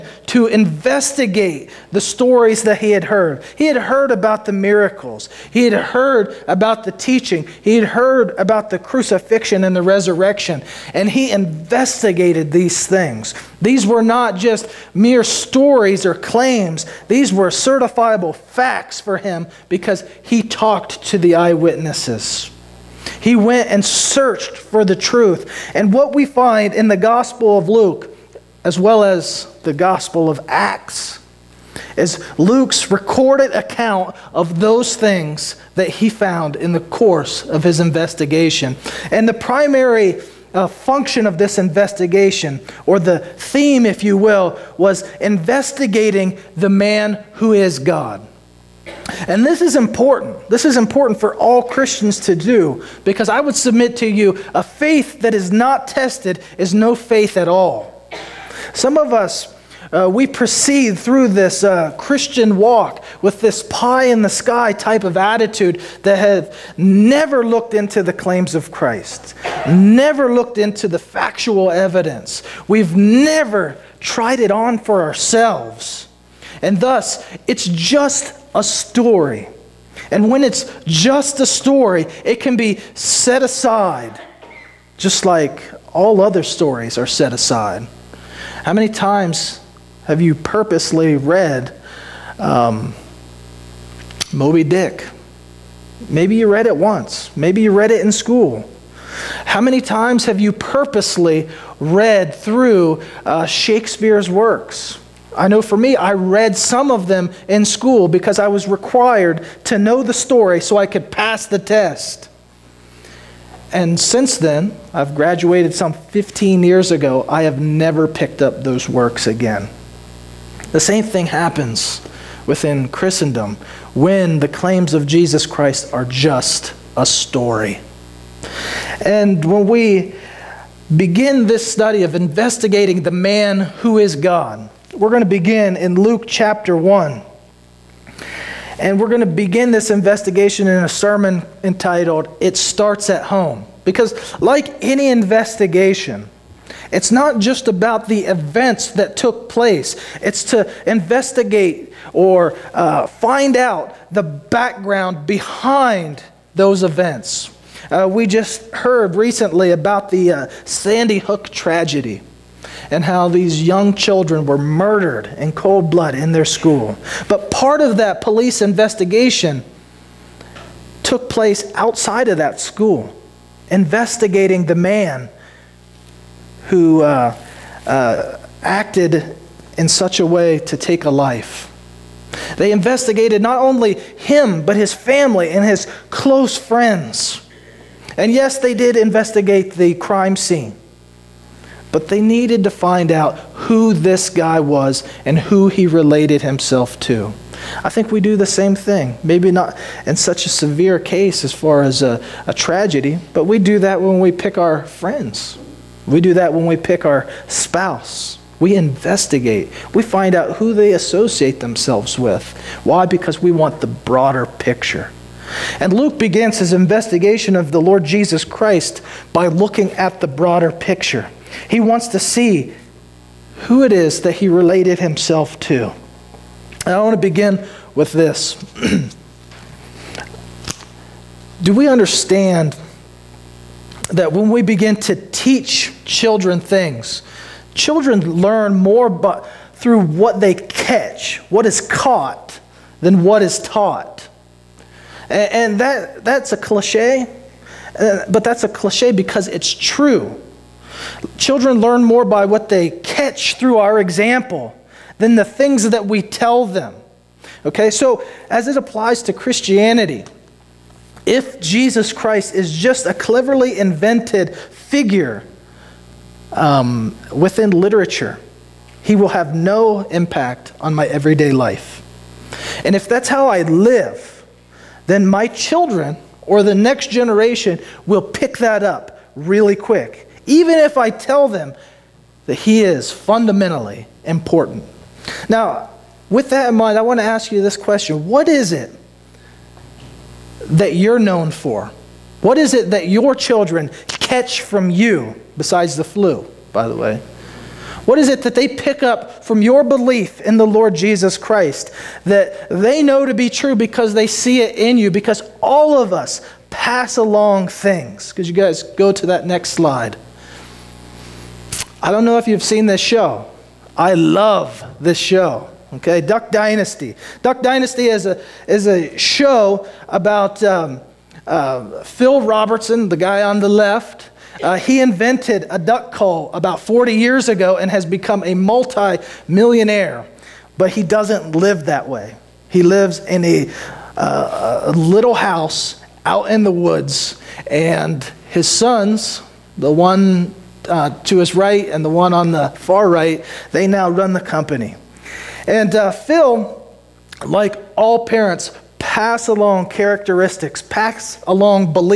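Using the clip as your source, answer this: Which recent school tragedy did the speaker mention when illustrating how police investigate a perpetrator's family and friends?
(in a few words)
Sandy Hook.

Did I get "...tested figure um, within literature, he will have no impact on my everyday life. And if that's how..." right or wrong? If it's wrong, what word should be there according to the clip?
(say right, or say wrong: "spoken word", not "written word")
wrong: "invented", not "tested".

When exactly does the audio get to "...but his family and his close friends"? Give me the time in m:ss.
3:04.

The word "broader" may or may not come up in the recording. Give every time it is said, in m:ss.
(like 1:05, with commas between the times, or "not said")
3:33, 3:40.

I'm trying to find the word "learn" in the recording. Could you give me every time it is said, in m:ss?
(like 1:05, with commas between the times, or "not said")
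3:58, 4:11.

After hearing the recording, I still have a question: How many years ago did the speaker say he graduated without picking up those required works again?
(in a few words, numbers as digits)
15.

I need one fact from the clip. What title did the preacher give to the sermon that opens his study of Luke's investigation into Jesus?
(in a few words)
It Starts at Home.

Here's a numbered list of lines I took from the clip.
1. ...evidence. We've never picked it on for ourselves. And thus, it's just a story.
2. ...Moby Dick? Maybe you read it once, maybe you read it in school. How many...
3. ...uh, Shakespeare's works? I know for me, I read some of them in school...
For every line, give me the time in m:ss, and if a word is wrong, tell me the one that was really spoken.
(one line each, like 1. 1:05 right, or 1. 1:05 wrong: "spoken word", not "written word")
1. 1:11 wrong: "tried", not "picked"
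2. 1:34 right
3. 1:43 right.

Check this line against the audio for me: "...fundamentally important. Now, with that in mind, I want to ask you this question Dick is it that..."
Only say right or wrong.
wrong.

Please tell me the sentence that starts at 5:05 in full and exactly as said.
Because all of us pass along things.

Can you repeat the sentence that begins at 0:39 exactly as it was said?
And the primary uh, function of this investigation, or the theme, if you will, was investigating the man who is God.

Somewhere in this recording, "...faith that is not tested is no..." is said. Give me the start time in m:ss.
0:54.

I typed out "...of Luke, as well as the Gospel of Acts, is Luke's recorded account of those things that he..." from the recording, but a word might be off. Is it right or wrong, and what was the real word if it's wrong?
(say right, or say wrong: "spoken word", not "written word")
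right.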